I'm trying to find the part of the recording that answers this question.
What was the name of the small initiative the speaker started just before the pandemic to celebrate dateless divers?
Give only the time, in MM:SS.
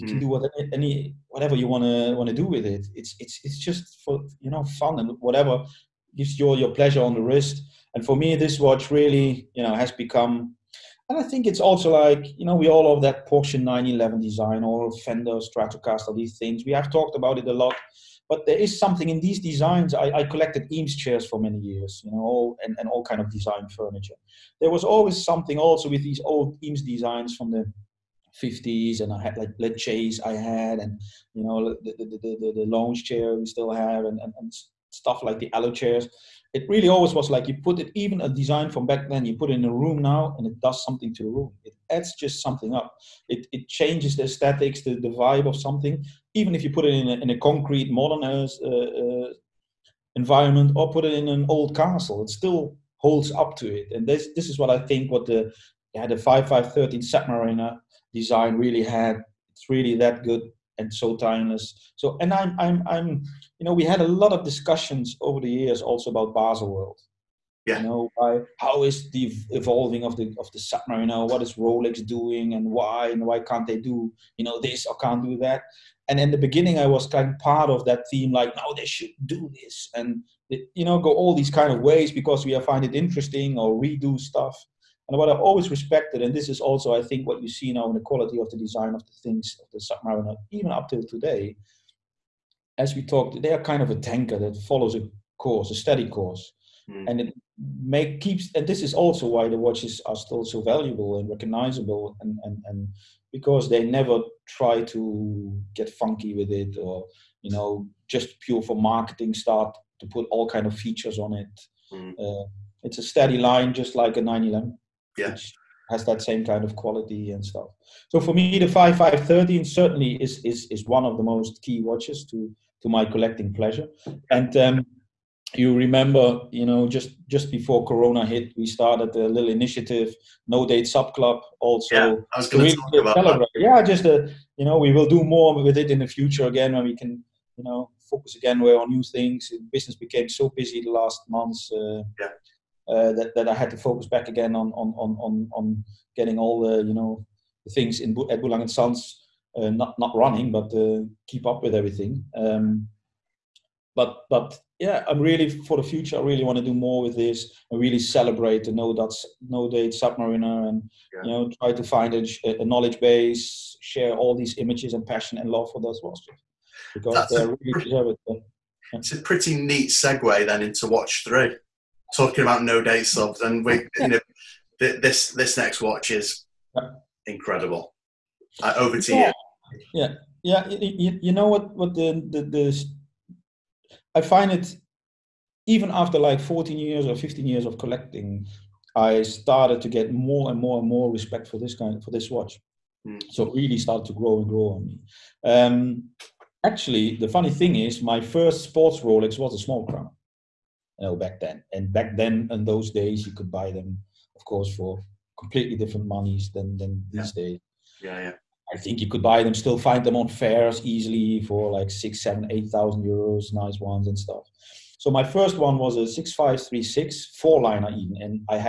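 02:10.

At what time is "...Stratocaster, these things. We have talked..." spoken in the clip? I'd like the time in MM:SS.
00:15.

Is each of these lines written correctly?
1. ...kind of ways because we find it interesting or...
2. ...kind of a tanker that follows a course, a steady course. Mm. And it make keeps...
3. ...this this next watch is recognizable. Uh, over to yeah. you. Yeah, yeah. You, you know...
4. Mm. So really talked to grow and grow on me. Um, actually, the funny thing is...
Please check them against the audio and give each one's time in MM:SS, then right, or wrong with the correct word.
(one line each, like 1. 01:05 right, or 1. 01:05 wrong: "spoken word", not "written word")
1. 01:21 right
2. 01:33 right
3. 02:54 wrong: "incredible", not "recognizable"
4. 03:13 wrong: "started", not "talked".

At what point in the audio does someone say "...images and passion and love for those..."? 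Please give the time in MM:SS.
02:44.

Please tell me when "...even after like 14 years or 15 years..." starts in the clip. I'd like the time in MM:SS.
03:05.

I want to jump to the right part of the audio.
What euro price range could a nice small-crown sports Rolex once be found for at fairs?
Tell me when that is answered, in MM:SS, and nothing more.
03:31.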